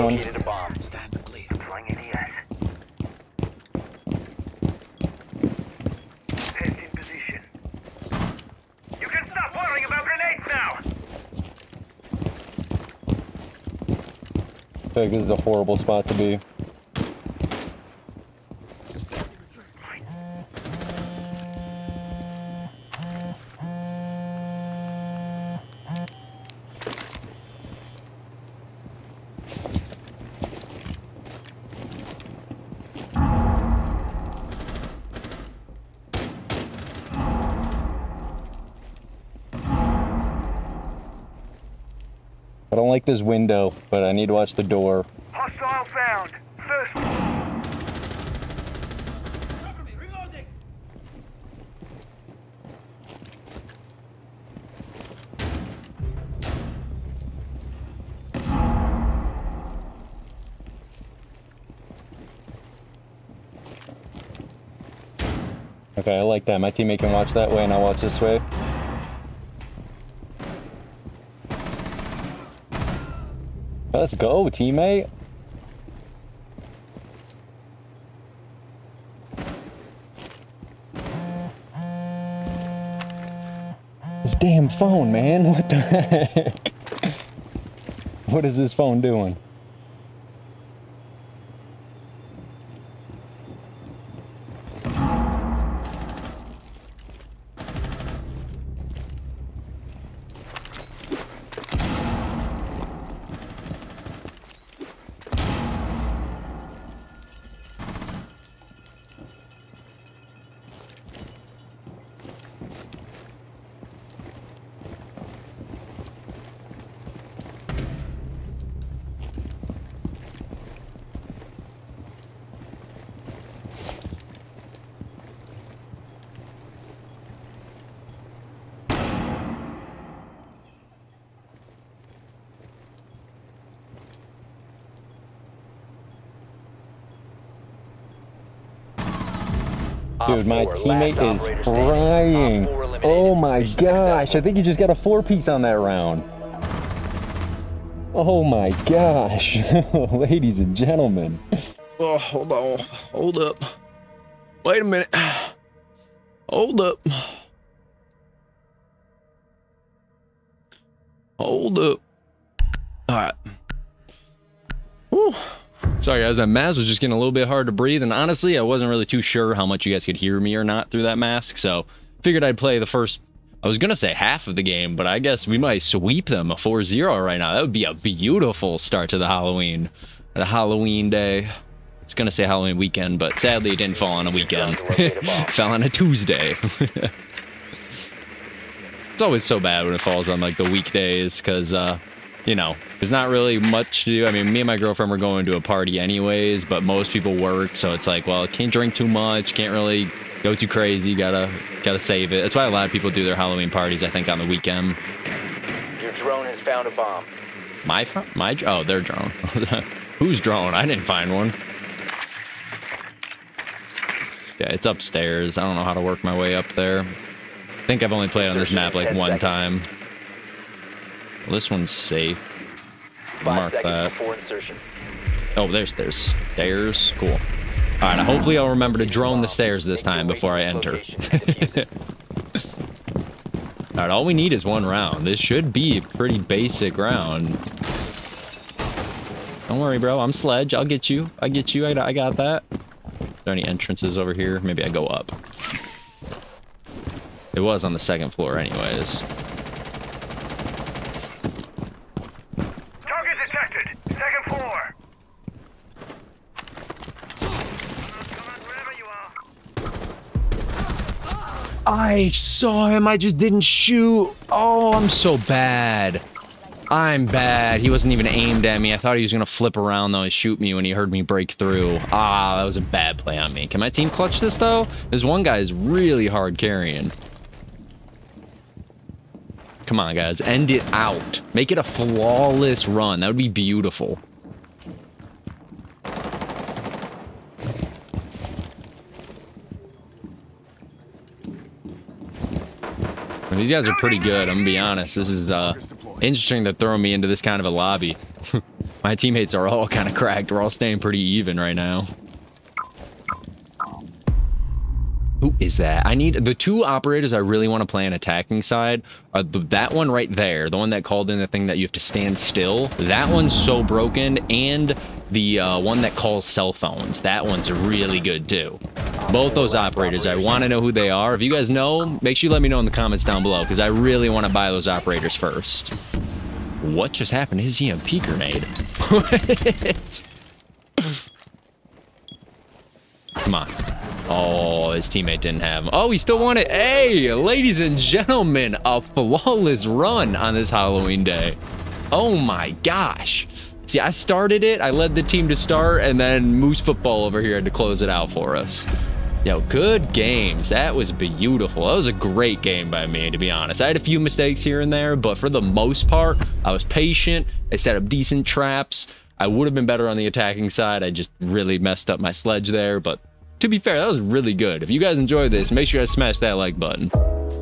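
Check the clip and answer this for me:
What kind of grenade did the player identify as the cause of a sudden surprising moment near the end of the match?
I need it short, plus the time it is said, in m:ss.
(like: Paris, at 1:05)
EMP grenade, at 5:27.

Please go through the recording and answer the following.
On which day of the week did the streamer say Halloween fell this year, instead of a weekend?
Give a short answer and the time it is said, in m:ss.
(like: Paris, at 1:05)
Tuesday, at 3:05.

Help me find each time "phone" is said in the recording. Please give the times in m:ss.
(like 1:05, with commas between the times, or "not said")
1:24, 1:28, 5:16.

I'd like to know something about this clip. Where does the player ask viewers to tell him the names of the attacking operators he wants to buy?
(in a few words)
the comments.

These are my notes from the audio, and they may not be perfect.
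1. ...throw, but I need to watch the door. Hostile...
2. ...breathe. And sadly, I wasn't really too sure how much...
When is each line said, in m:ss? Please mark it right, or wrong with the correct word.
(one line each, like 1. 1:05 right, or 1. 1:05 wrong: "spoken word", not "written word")
1. 0:43 wrong: "window", not "throw"
2. 2:47 wrong: "honestly", not "sadly".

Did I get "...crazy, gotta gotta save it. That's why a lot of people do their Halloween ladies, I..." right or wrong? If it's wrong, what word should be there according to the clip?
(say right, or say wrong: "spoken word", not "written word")
wrong: "parties", not "ladies".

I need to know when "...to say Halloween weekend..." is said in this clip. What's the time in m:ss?
3:02.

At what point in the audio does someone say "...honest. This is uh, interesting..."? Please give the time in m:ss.
4:54.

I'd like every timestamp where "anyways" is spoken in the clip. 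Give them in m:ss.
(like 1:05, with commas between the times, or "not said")
3:15, 4:08.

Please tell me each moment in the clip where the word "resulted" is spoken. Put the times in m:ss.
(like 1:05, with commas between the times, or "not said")
not said.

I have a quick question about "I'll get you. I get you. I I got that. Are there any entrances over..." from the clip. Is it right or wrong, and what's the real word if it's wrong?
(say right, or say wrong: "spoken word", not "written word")
right.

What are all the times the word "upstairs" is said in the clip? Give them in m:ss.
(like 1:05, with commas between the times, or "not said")
3:34.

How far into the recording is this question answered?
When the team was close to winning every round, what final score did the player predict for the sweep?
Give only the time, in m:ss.
2:56.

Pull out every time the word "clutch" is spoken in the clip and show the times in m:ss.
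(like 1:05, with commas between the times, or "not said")
4:34.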